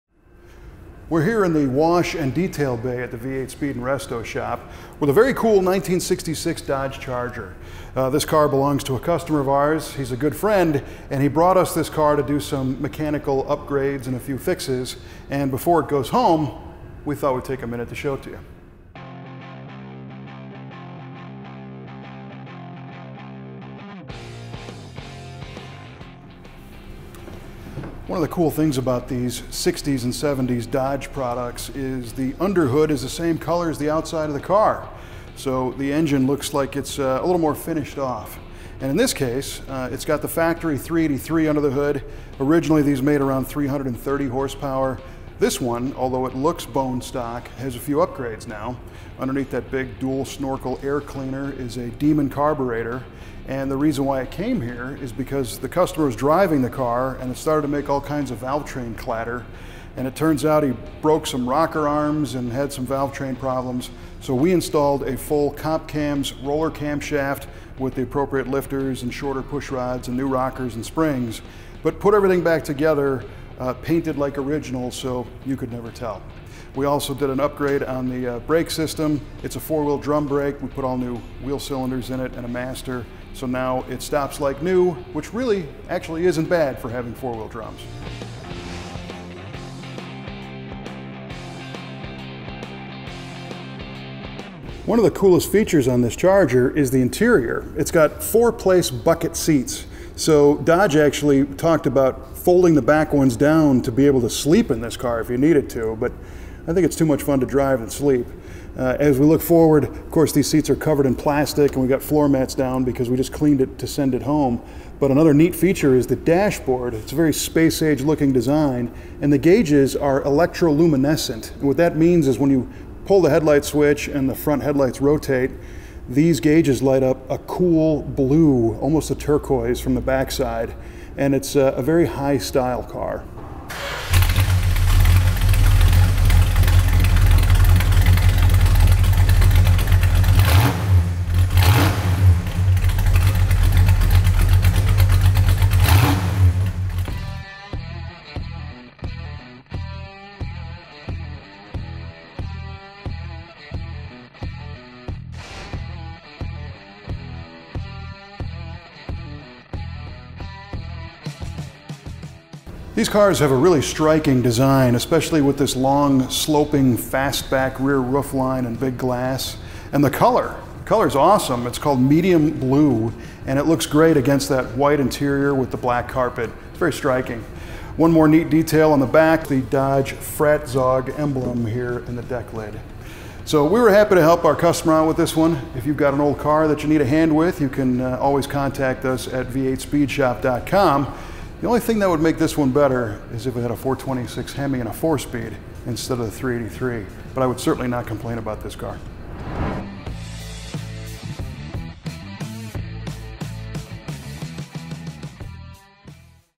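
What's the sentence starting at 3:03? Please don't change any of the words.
So we were happy to help our customer out with this one.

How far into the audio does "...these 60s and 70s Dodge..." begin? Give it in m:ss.
0:29.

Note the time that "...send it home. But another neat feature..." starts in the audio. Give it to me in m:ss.
1:53.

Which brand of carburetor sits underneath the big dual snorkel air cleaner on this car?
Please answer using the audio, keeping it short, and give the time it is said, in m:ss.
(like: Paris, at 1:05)
Demon, at 0:51.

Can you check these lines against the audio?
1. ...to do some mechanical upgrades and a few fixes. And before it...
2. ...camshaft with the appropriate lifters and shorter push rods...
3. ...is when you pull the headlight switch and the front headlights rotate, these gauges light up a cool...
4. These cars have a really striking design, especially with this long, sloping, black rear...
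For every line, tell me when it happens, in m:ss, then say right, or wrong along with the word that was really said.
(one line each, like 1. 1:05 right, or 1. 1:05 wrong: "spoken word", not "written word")
1. 0:12 right
2. 1:06 right
3. 2:02 right
4. 2:42 wrong: "fastback", not "black".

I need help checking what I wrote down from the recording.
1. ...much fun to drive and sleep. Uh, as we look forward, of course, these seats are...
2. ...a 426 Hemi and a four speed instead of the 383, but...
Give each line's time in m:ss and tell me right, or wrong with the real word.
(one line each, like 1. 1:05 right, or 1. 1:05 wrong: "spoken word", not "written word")
1. 1:47 right
2. 3:13 right.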